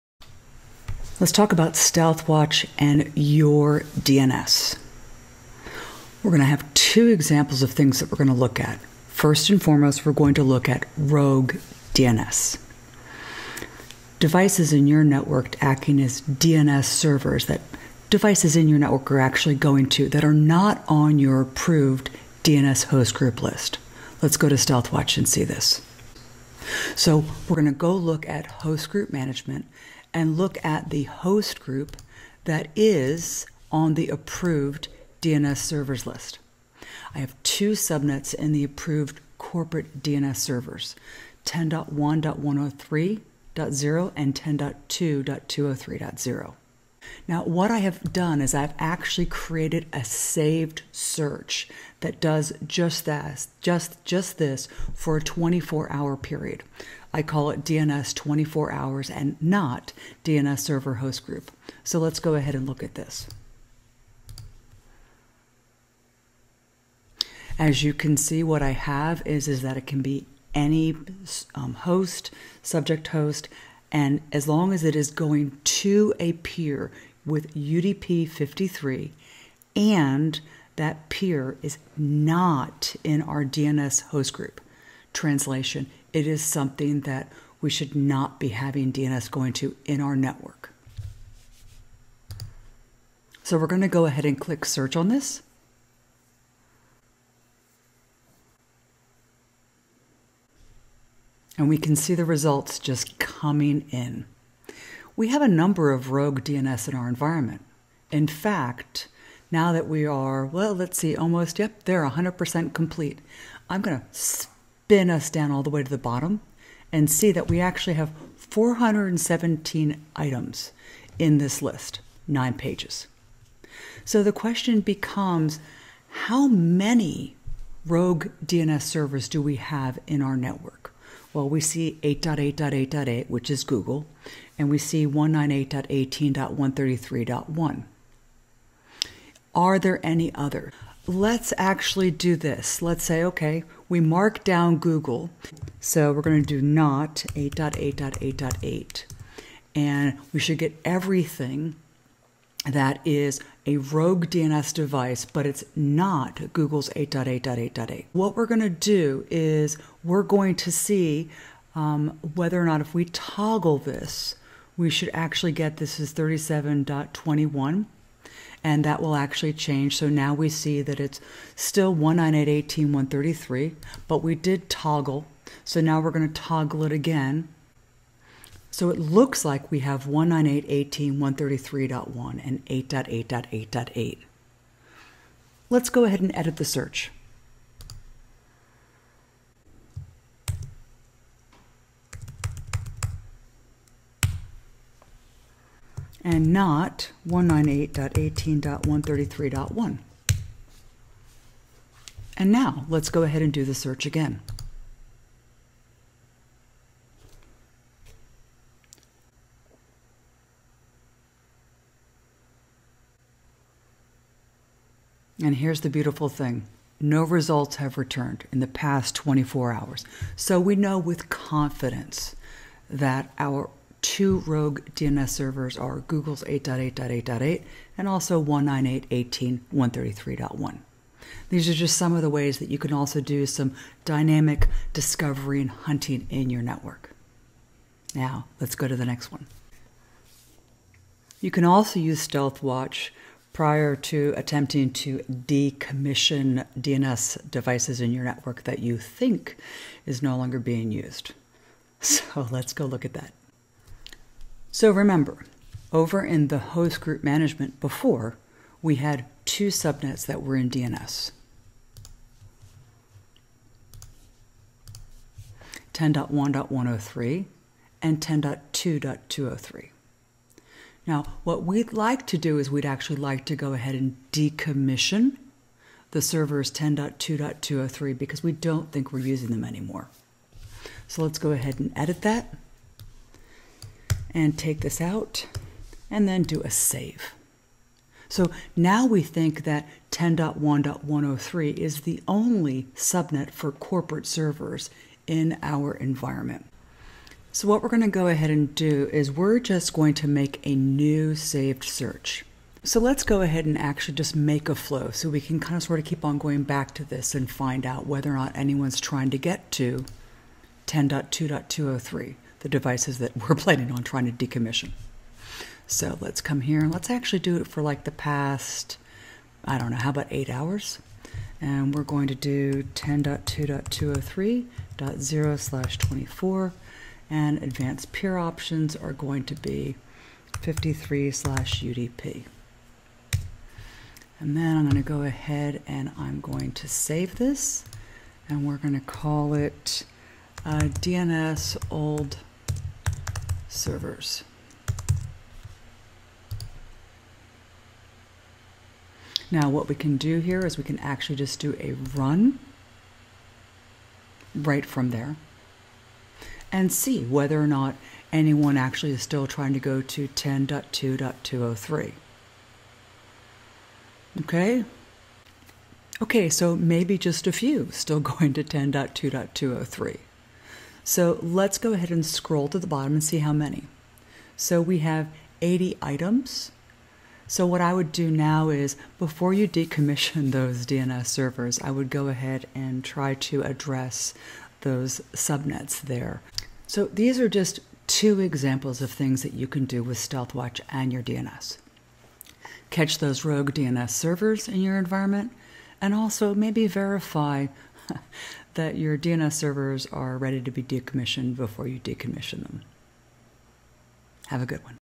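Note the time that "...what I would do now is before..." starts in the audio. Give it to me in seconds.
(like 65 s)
377 s.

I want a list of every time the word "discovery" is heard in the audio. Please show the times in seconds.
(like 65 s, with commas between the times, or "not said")
234 s.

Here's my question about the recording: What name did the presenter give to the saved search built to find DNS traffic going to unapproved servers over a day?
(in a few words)
DNS 24 hours and not DNS server host group.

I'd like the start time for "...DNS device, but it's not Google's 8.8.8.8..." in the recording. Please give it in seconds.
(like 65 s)
154 s.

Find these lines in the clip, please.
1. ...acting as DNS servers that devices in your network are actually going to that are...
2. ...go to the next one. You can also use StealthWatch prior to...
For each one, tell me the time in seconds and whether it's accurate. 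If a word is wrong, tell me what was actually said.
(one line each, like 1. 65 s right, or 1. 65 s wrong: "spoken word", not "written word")
1. 15 s right
2. 238 s right.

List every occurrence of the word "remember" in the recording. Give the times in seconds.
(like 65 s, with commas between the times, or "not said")
254 s.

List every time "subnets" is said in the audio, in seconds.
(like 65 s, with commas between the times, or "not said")
37 s, 259 s, 292 s, 385 s.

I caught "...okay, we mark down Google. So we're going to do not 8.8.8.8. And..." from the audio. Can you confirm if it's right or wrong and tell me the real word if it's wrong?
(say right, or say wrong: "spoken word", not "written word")
right.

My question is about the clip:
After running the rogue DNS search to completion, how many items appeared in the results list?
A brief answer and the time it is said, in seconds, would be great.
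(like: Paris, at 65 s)
417, at 118 s.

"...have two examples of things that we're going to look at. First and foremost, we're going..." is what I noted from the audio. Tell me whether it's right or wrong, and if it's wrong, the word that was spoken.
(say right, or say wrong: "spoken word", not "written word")
right.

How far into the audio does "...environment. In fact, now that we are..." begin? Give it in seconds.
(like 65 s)
107 s.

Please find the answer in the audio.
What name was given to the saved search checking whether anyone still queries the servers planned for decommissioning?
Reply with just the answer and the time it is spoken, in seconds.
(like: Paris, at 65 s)
DNS old servers, at 340 s.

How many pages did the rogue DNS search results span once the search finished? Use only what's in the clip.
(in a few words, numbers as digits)
9.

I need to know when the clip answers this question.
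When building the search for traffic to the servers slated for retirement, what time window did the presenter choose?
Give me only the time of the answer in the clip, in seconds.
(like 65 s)
320 s.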